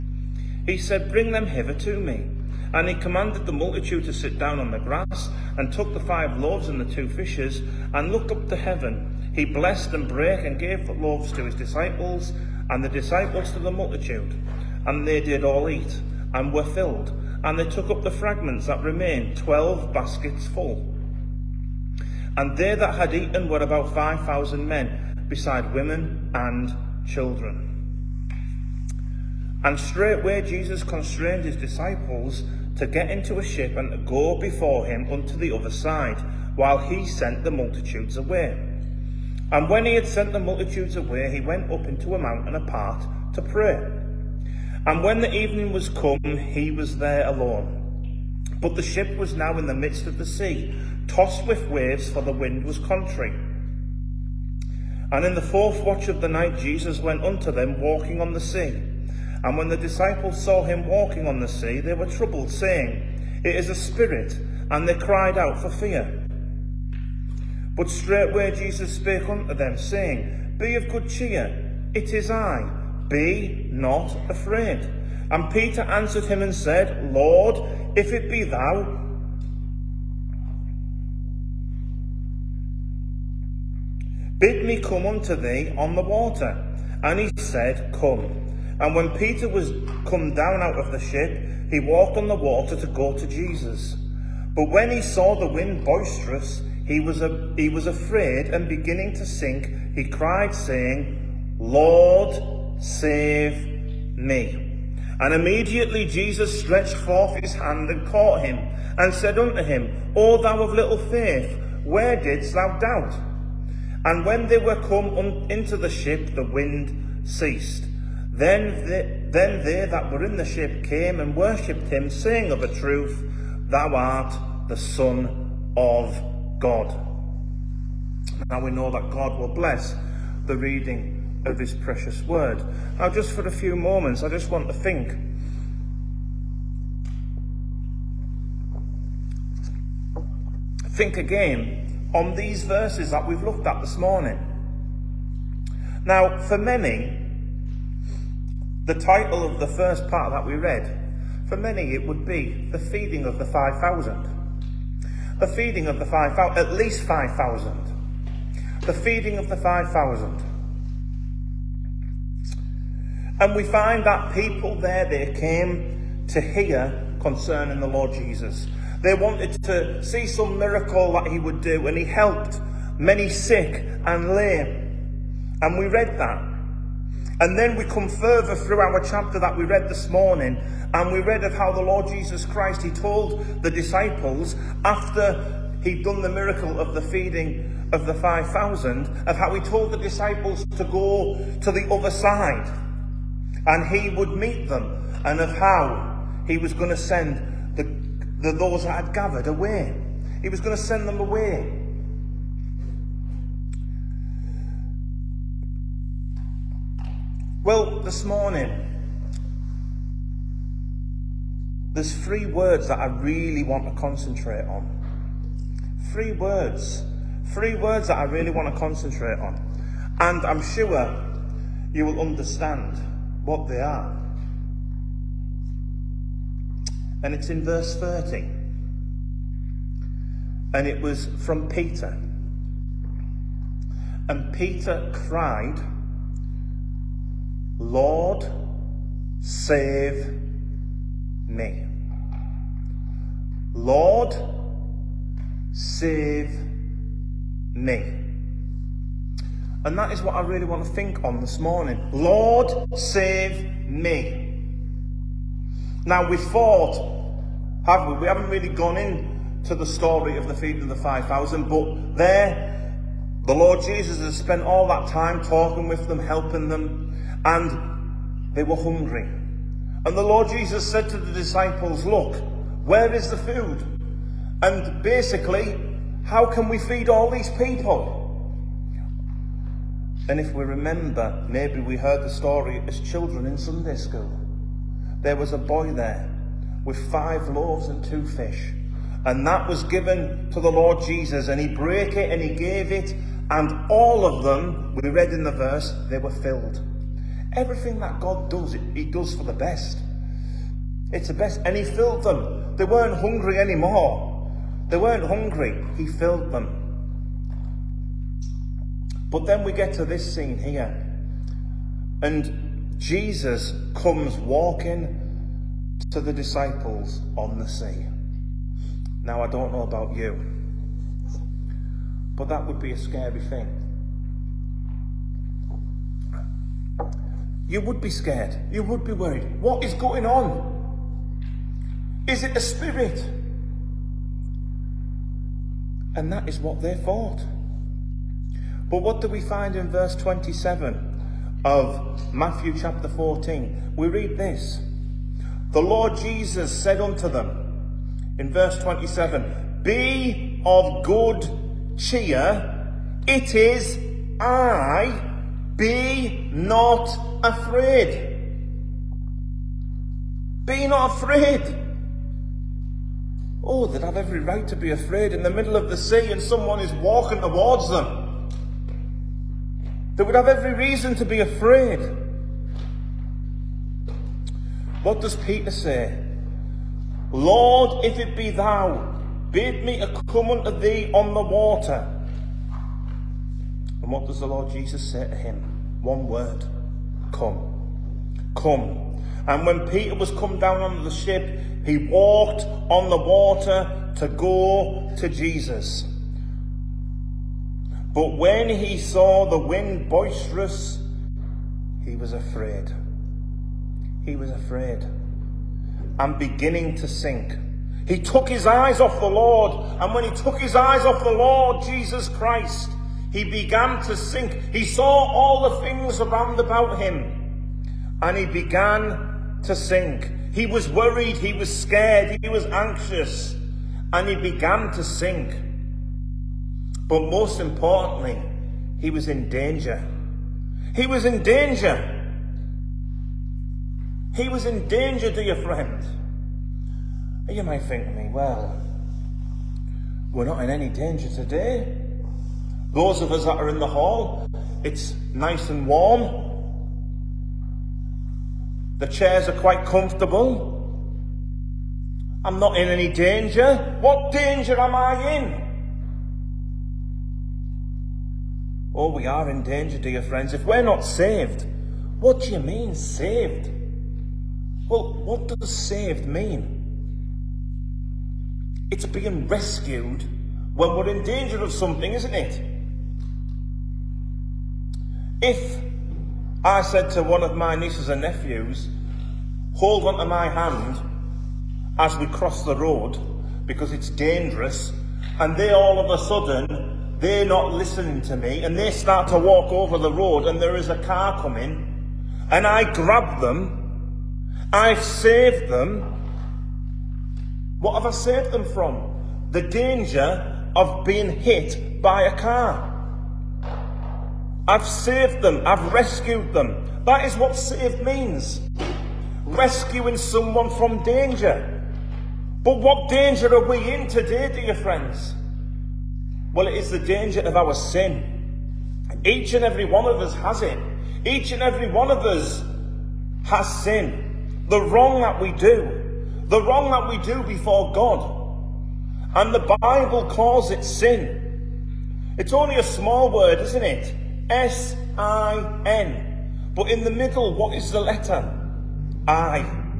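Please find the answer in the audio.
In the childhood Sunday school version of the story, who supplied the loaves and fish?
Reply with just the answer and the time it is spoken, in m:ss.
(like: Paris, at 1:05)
a boy, at 4:45.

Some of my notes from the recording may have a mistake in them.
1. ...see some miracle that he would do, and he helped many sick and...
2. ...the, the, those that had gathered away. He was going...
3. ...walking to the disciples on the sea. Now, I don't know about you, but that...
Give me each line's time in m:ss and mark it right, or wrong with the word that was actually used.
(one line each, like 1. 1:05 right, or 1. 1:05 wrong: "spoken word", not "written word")
1. 2:50 right
2. 3:17 right
3. 5:14 right.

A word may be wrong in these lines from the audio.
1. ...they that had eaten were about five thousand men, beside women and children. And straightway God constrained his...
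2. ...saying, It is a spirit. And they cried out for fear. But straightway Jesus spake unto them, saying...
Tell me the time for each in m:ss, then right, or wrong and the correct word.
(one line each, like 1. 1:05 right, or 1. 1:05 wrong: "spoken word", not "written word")
1. 0:22 wrong: "Jesus", not "God"
2. 1:02 right.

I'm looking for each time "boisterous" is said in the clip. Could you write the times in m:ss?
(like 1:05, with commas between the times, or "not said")
1:35, 6:40.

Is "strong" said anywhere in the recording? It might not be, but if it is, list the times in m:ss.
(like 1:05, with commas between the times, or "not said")
not said.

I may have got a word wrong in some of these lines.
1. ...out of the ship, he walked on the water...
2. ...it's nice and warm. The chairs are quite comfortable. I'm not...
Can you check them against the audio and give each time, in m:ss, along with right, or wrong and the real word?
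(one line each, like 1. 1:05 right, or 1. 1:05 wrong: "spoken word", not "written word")
1. 1:30 right
2. 7:24 right.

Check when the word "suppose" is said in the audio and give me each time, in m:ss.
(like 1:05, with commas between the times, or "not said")
not said.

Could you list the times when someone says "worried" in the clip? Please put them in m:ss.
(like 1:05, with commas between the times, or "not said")
5:29, 7:00.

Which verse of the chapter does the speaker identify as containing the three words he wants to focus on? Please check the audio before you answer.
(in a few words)
verse 30.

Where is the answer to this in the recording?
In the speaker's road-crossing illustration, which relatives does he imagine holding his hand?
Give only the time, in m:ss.
7:57.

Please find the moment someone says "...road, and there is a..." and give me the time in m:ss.
8:10.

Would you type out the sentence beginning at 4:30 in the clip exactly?
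And the Lord Jesus said to the disciples, Look, where is the food?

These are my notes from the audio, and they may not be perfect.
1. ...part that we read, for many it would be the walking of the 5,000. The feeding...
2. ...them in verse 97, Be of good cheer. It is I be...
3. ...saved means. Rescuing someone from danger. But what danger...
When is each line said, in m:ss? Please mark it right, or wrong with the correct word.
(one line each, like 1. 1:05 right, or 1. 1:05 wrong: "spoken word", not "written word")
1. 2:30 wrong: "feeding", not "walking"
2. 5:47 wrong: "27", not "97"
3. 8:27 right.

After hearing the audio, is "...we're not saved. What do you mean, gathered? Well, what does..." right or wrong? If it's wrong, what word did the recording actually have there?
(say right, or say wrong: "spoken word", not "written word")
wrong: "saved", not "gathered".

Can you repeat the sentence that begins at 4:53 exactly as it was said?
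And all of them, we read in the verse, they were filled.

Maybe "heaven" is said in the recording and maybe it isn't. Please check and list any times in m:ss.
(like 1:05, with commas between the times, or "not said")
0:08.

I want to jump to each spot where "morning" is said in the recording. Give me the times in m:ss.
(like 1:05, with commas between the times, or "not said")
2:23, 3:00, 3:28, 4:11.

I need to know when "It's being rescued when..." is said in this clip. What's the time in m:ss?
7:48.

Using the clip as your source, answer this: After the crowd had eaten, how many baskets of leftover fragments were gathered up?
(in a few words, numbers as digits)
12.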